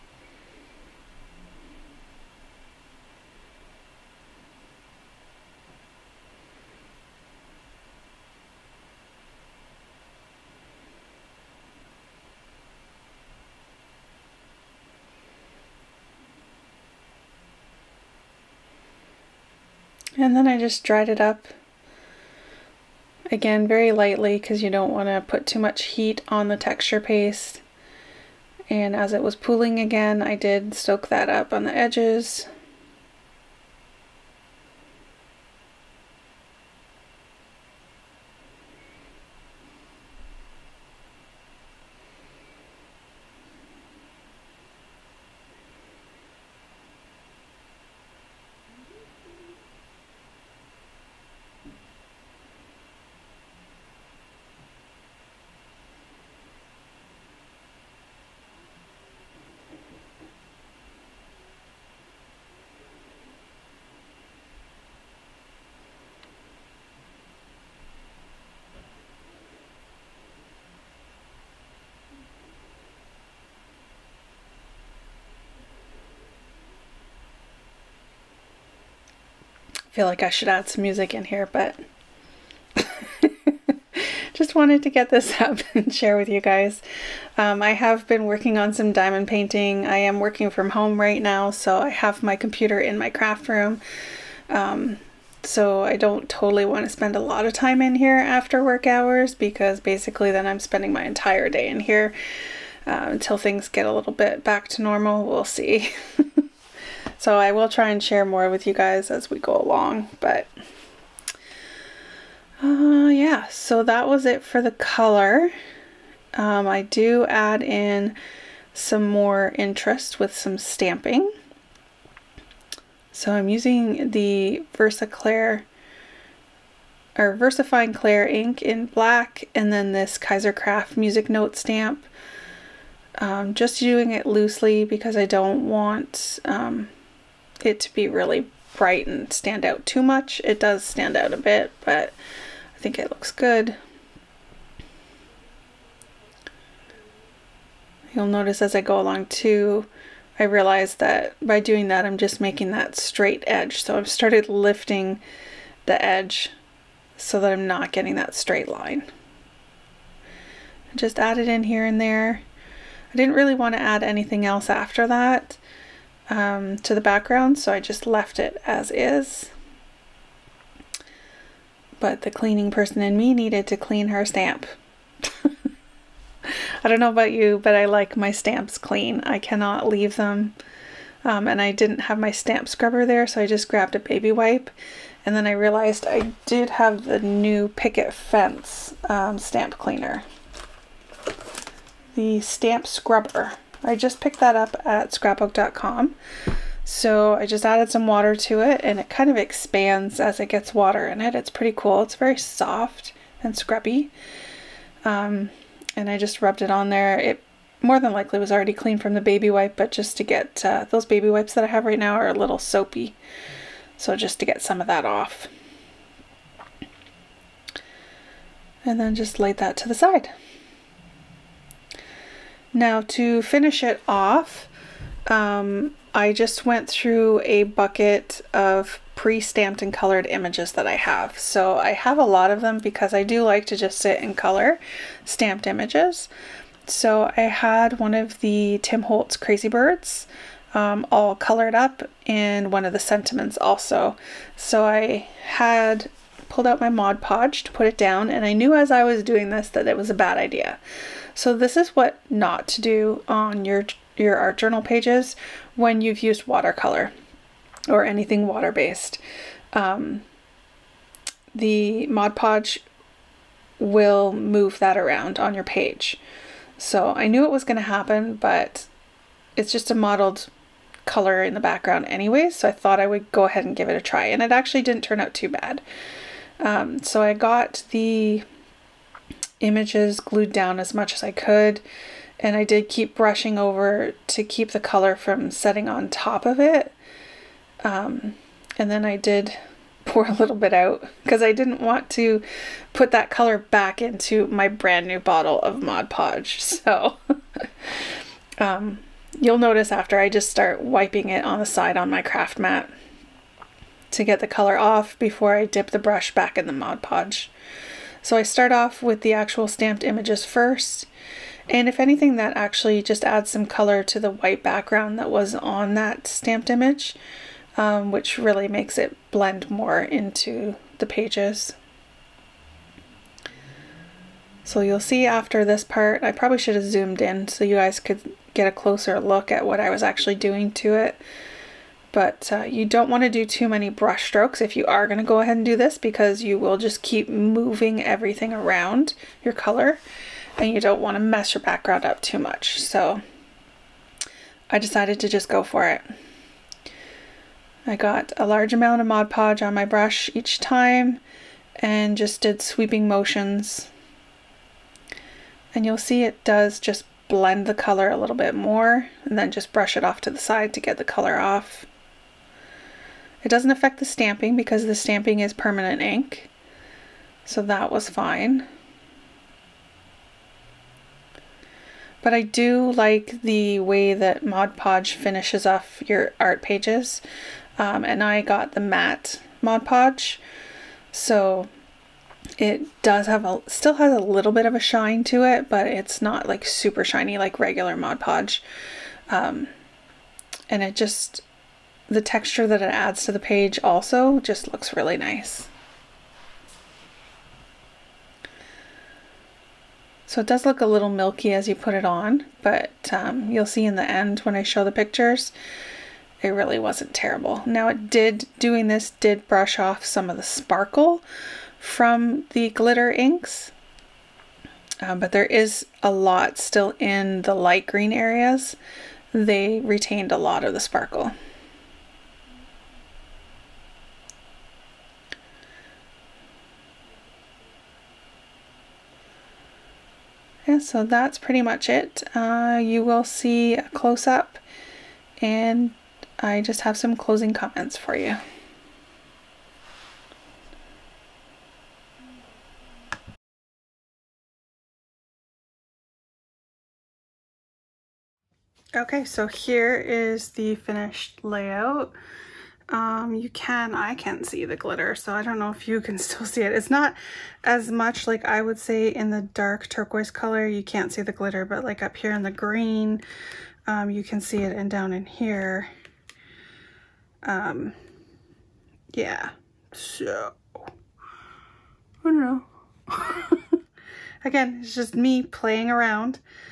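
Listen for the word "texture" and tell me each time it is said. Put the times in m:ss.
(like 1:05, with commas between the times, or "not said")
0:26, 6:32.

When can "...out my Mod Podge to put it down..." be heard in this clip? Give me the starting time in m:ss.
4:06.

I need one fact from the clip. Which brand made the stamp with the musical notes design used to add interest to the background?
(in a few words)
Kaiser Craft.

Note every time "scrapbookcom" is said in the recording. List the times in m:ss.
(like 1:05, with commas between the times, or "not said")
3:15.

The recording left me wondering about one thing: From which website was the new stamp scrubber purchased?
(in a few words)
scrapbook.com.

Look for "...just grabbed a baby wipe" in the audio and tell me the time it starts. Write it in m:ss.
3:03.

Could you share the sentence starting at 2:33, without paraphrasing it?
So I've started lifting the edge so that I'm not getting that straight line.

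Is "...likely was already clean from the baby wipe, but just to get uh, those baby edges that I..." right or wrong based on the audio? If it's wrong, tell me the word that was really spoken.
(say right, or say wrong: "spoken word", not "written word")
wrong: "wipes", not "edges".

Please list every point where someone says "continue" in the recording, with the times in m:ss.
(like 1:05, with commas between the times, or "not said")
not said.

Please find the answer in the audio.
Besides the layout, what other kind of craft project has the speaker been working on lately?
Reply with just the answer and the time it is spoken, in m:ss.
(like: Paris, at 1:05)
Diamond painting, at 1:28.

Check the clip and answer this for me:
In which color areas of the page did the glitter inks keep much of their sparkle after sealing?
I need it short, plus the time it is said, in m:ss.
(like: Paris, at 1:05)
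Light green, at 6:57.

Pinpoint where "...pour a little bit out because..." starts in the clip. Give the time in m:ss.
4:50.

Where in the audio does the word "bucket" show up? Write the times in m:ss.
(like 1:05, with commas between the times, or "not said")
3:47.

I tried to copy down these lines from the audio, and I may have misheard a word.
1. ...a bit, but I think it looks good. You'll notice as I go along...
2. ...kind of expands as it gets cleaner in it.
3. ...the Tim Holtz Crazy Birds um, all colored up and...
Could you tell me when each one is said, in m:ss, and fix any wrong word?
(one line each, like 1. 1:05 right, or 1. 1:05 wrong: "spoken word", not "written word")
1. 2:21 right
2. 3:19 wrong: "water", not "cleaner"
3. 3:58 right.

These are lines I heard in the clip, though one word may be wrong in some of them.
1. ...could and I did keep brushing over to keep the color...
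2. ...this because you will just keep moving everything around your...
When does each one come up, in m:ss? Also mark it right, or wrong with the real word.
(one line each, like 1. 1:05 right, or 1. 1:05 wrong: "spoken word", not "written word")
1. 4:41 right
2. 5:35 right.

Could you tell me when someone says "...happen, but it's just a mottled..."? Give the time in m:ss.
4:27.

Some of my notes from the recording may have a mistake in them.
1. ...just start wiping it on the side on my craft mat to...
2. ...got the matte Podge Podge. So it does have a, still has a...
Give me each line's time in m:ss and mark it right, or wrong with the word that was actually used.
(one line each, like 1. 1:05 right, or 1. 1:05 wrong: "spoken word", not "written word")
1. 5:00 right
2. 6:18 wrong: "Mod", not "Podge".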